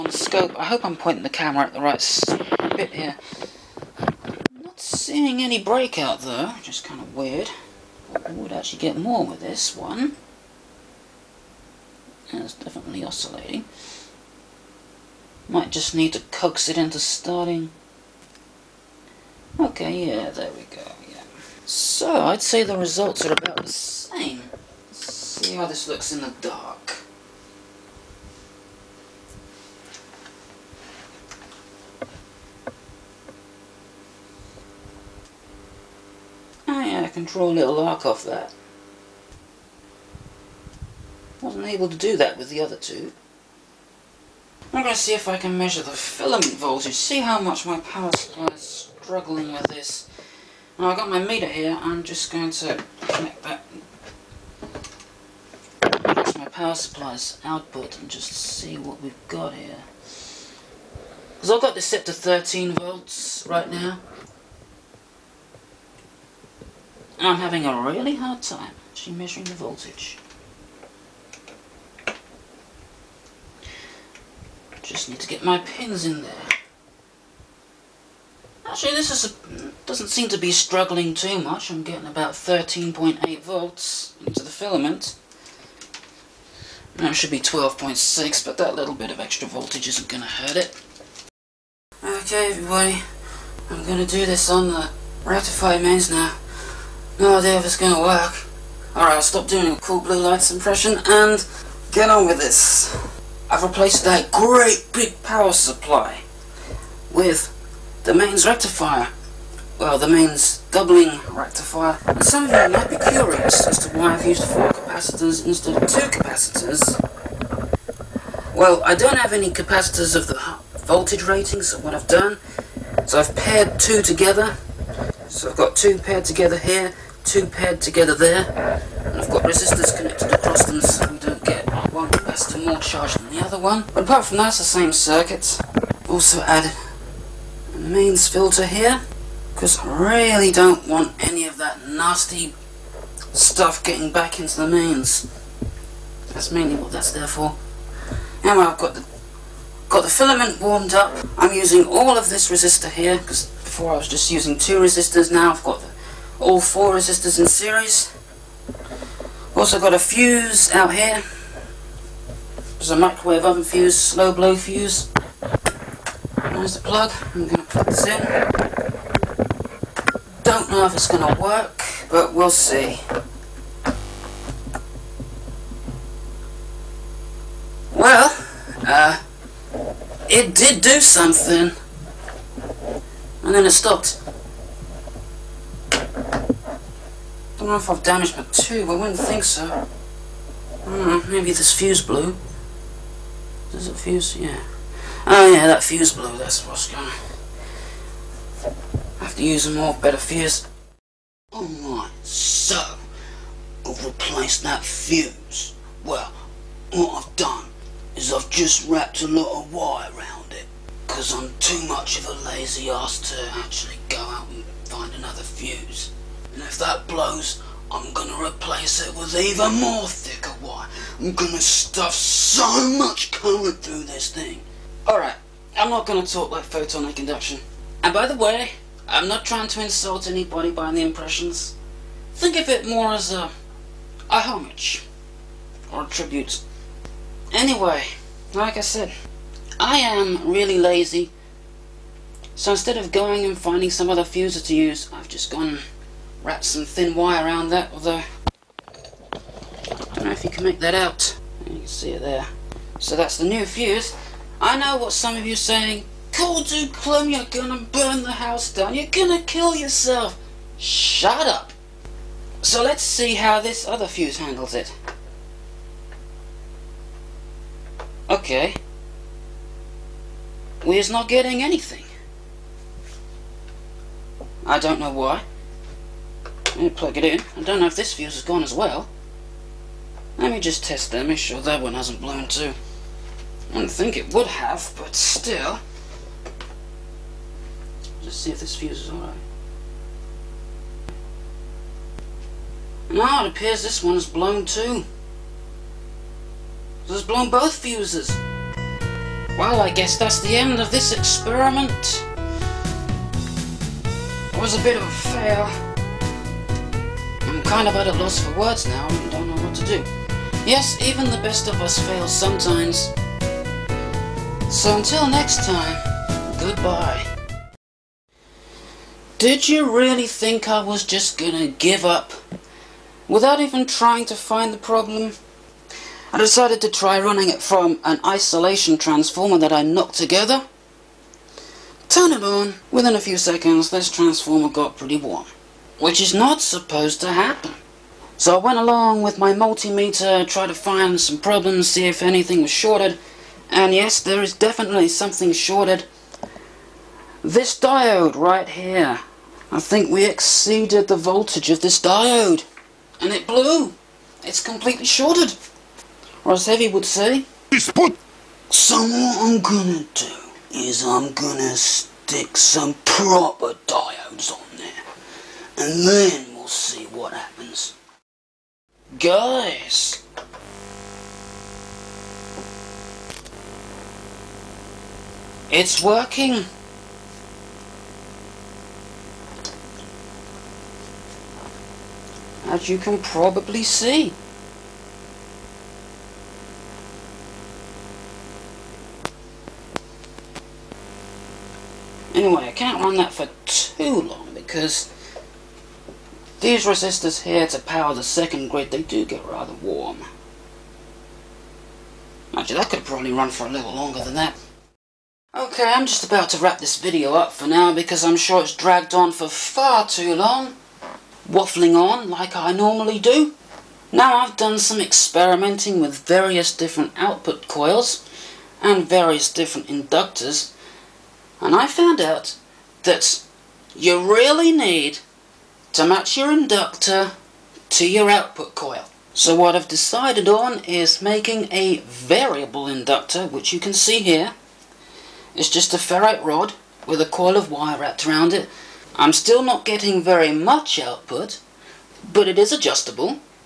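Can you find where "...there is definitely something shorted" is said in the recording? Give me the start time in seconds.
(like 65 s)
344 s.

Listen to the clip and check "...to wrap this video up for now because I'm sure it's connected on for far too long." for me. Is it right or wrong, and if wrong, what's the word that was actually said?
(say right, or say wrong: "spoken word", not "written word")
wrong: "dragged", not "connected".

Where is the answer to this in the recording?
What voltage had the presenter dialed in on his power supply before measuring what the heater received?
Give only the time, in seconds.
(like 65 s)
62 s.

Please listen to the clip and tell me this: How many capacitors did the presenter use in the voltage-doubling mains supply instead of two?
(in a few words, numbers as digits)
4.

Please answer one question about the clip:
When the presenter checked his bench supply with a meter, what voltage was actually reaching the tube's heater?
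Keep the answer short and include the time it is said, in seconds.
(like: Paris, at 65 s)
13.8 volts, at 82 s.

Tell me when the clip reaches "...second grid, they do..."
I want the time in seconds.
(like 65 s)
398 s.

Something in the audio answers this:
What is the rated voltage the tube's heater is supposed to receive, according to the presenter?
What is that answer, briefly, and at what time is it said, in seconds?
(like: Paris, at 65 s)
12.6, at 87 s.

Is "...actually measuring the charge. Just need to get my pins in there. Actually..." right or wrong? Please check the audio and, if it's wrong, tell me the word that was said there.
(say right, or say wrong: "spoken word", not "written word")
wrong: "voltage", not "charge".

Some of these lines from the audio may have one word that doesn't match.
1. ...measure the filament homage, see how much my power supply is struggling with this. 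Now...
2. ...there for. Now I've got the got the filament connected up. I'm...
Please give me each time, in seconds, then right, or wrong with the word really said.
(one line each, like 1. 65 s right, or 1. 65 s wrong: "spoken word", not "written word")
1. 45 s wrong: "voltage", not "homage"
2. 147 s wrong: "warmed", not "connected".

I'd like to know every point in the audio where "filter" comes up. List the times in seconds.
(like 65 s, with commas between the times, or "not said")
138 s.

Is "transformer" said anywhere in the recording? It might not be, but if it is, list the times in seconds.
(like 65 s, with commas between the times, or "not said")
328 s, 334 s.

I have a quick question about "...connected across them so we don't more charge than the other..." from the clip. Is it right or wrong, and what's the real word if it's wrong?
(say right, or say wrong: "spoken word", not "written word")
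right.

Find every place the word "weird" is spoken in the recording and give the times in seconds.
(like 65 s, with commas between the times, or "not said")
7 s.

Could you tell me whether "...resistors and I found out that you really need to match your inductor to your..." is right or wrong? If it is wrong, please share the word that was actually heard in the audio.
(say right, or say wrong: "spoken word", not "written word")
wrong: "inductors", not "resistors".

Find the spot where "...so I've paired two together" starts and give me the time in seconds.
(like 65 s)
123 s.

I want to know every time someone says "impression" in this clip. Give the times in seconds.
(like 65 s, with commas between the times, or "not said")
100 s, 231 s.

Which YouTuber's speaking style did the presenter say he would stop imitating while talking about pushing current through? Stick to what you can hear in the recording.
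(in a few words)
Photonic Induction.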